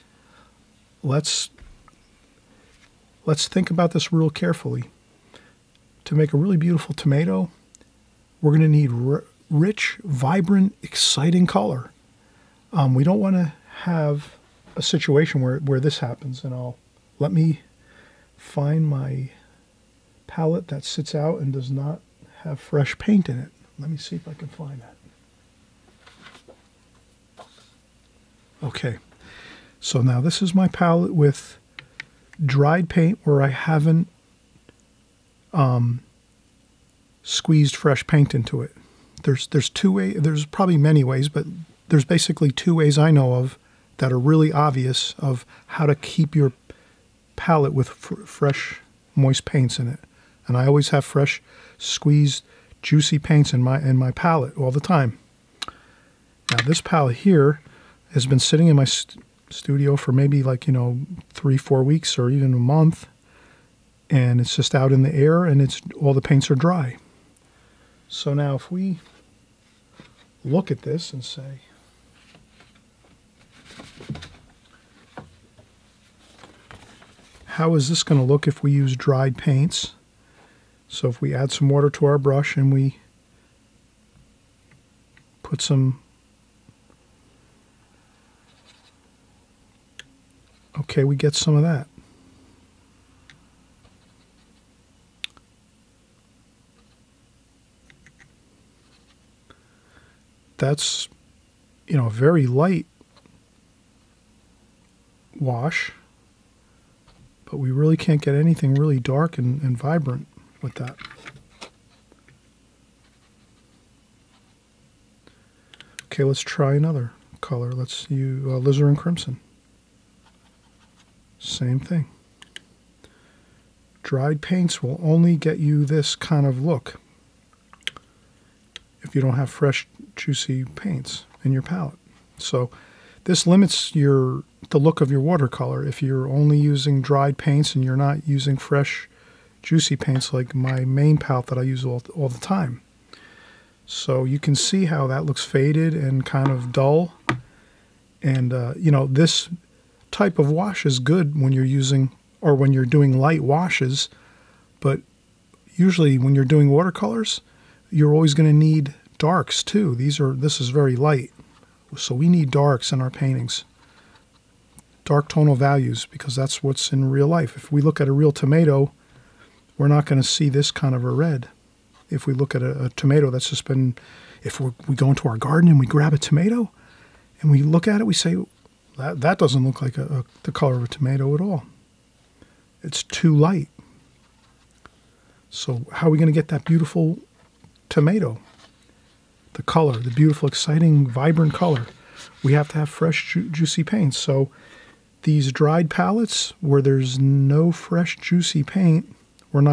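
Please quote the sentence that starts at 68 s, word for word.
So now if we look at this and say, how is this going to look if we use dried paints?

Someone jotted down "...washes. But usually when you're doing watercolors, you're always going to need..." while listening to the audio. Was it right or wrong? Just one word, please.
right.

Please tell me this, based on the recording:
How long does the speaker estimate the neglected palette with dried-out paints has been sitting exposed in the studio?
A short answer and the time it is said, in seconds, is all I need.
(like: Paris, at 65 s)
3 to 4 weeks, at 61 s.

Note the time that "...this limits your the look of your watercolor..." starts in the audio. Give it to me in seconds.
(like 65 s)
133 s.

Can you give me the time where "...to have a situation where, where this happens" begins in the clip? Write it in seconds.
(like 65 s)
13 s.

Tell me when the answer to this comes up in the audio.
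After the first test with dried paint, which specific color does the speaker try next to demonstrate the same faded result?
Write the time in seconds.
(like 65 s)
118 s.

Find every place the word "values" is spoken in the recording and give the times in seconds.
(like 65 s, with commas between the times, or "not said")
165 s.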